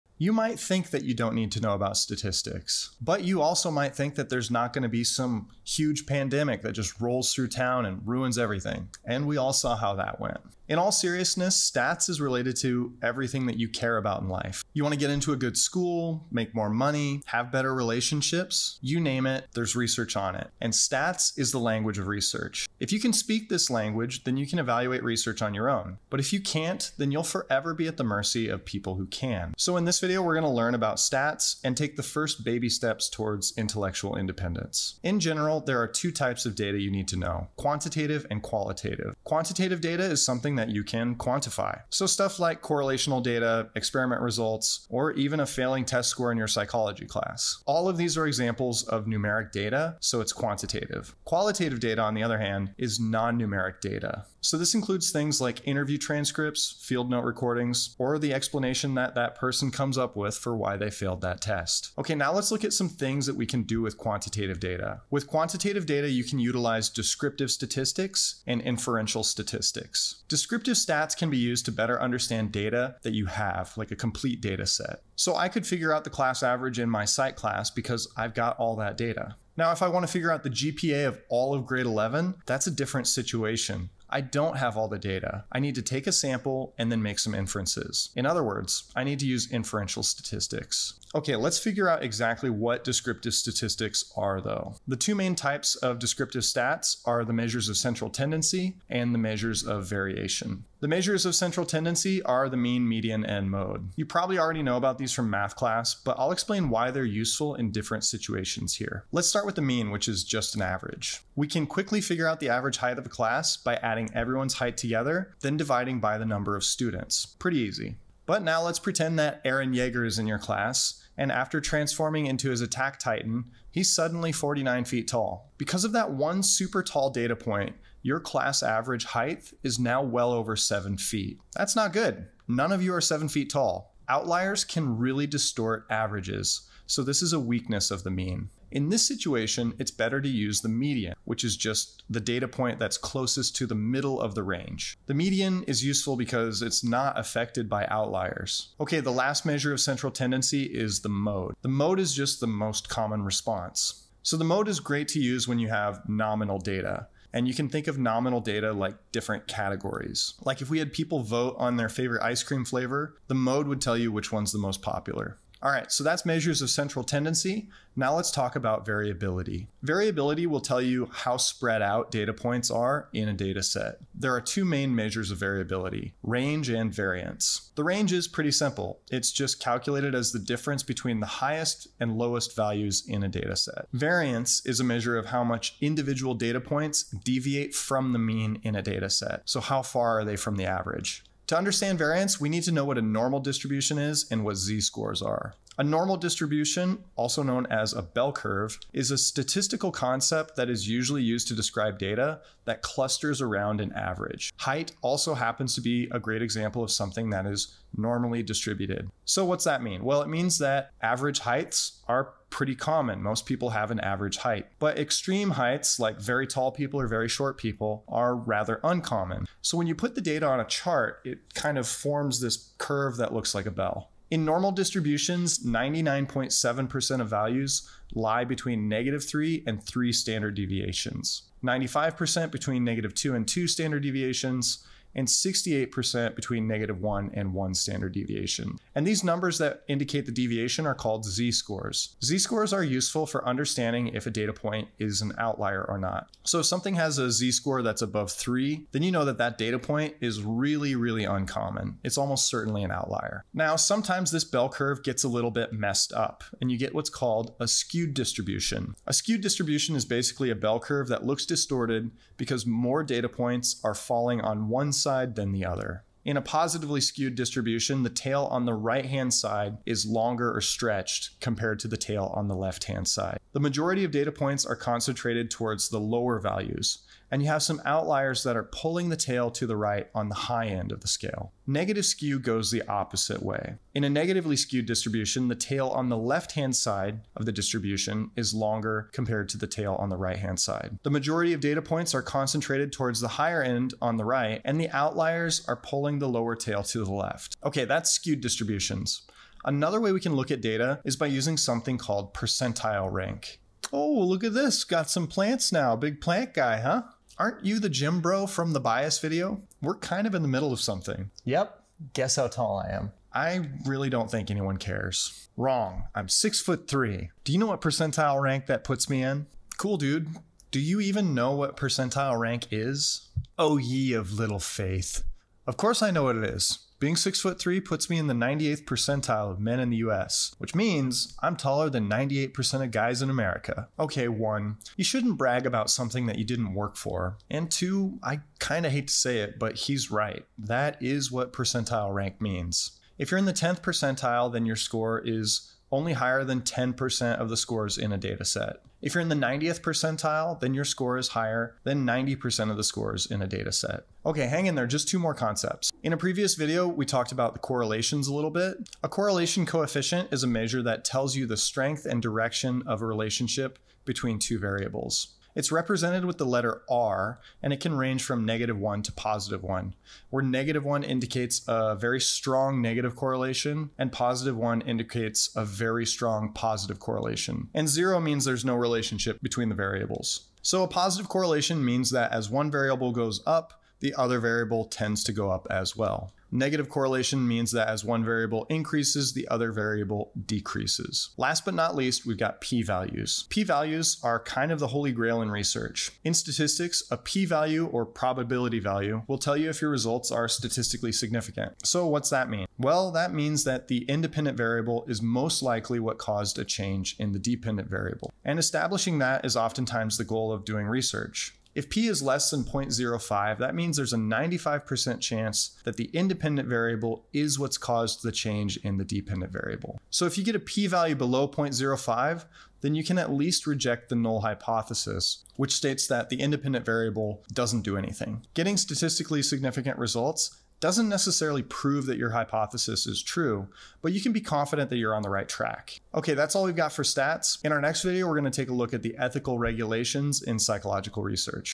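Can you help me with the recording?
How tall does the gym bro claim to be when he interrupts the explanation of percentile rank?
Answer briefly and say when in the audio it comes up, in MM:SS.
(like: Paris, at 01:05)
6 foot 3, at 05:16.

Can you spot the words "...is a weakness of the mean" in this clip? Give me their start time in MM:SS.
02:17.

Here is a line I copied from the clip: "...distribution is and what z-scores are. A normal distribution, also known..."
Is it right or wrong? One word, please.
right.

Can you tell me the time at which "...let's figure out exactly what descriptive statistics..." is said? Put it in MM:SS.
01:31.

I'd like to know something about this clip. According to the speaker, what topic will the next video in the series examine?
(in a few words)
ethical regulations.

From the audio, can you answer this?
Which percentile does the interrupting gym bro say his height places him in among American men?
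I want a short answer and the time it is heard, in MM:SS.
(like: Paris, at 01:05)
98th percentile, at 05:28.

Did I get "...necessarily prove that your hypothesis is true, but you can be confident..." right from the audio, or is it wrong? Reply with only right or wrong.
right.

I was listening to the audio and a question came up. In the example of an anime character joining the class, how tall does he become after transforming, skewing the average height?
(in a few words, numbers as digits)
49 feet.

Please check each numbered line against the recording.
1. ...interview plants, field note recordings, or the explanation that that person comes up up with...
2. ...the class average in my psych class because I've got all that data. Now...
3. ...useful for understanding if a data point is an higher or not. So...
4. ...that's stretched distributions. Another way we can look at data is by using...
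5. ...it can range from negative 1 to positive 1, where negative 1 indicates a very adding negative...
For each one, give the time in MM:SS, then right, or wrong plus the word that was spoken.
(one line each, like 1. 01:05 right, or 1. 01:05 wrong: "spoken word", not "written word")
1. 00:55 wrong: "transcripts", not "plants"
2. 01:16 right
3. 04:02 wrong: "outlier", not "higher"
4. 04:57 wrong: "skewed", not "stretched"
5. 06:07 wrong: "strong", not "adding".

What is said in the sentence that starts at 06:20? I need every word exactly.
So a positive correlation means that as one variable goes up, the other variable tends to go up as well.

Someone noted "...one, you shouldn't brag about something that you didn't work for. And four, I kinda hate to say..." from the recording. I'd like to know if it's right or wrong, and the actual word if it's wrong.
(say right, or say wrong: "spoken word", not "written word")
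wrong: "two", not "four".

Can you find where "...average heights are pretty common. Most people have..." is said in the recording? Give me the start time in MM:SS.
03:31.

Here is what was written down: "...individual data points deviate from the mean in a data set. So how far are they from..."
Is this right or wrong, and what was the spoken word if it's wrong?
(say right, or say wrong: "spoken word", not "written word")
right.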